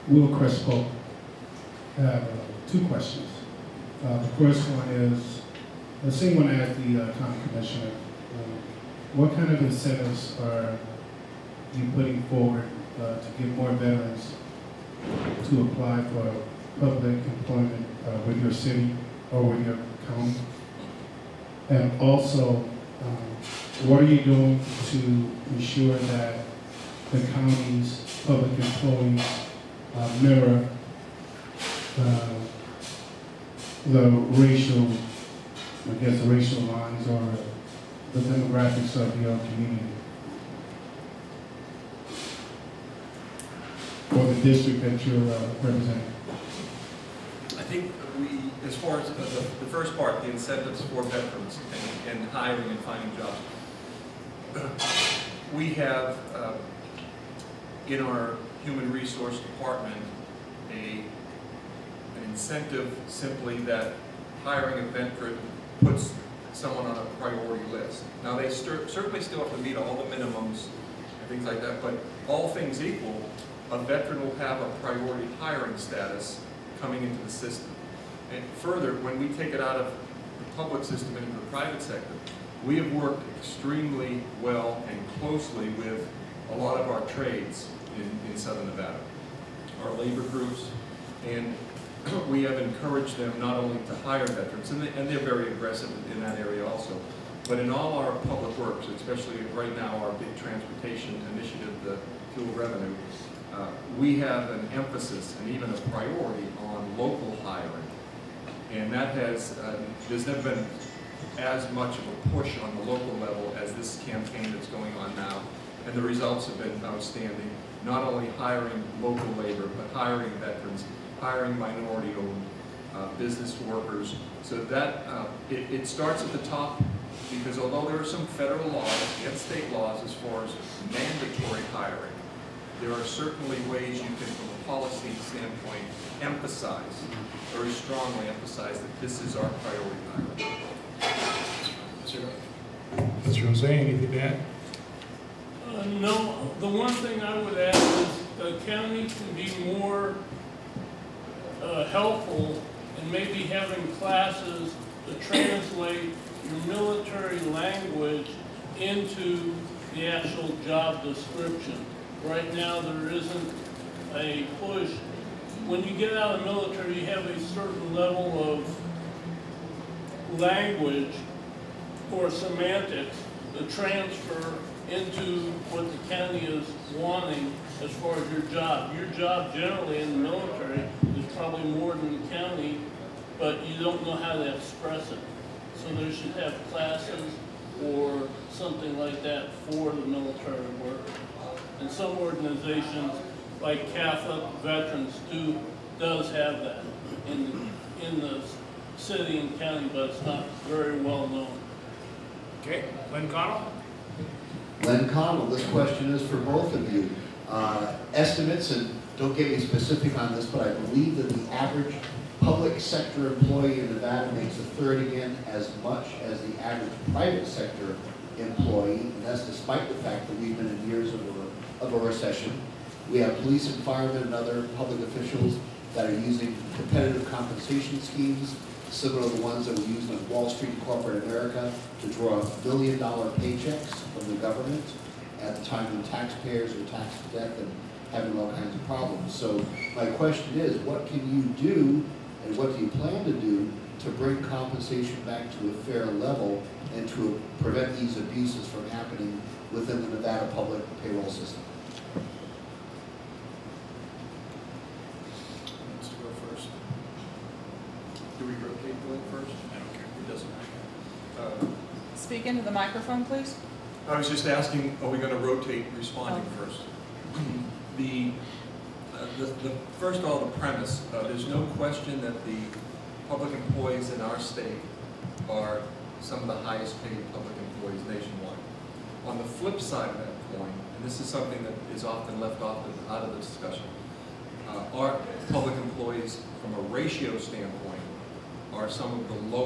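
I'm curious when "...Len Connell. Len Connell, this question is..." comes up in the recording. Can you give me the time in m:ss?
3:23.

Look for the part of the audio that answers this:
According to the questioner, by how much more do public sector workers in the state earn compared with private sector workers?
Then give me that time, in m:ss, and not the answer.
3:34.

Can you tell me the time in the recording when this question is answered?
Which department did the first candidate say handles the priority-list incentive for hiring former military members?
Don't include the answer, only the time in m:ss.
0:58.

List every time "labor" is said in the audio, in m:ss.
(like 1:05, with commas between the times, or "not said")
1:29, 1:59.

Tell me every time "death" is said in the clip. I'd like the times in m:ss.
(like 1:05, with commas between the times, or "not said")
3:57.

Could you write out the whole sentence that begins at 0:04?
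Uh, the first one is, the same one as the uh, county commissioner.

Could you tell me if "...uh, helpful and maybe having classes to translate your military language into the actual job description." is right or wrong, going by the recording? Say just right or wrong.
right.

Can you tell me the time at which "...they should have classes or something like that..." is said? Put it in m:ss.
3:05.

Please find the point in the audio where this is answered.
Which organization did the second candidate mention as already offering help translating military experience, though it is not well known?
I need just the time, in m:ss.
3:13.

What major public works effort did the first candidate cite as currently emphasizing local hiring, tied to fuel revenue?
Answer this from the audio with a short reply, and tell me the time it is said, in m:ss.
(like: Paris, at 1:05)
Transportation initiative, at 1:40.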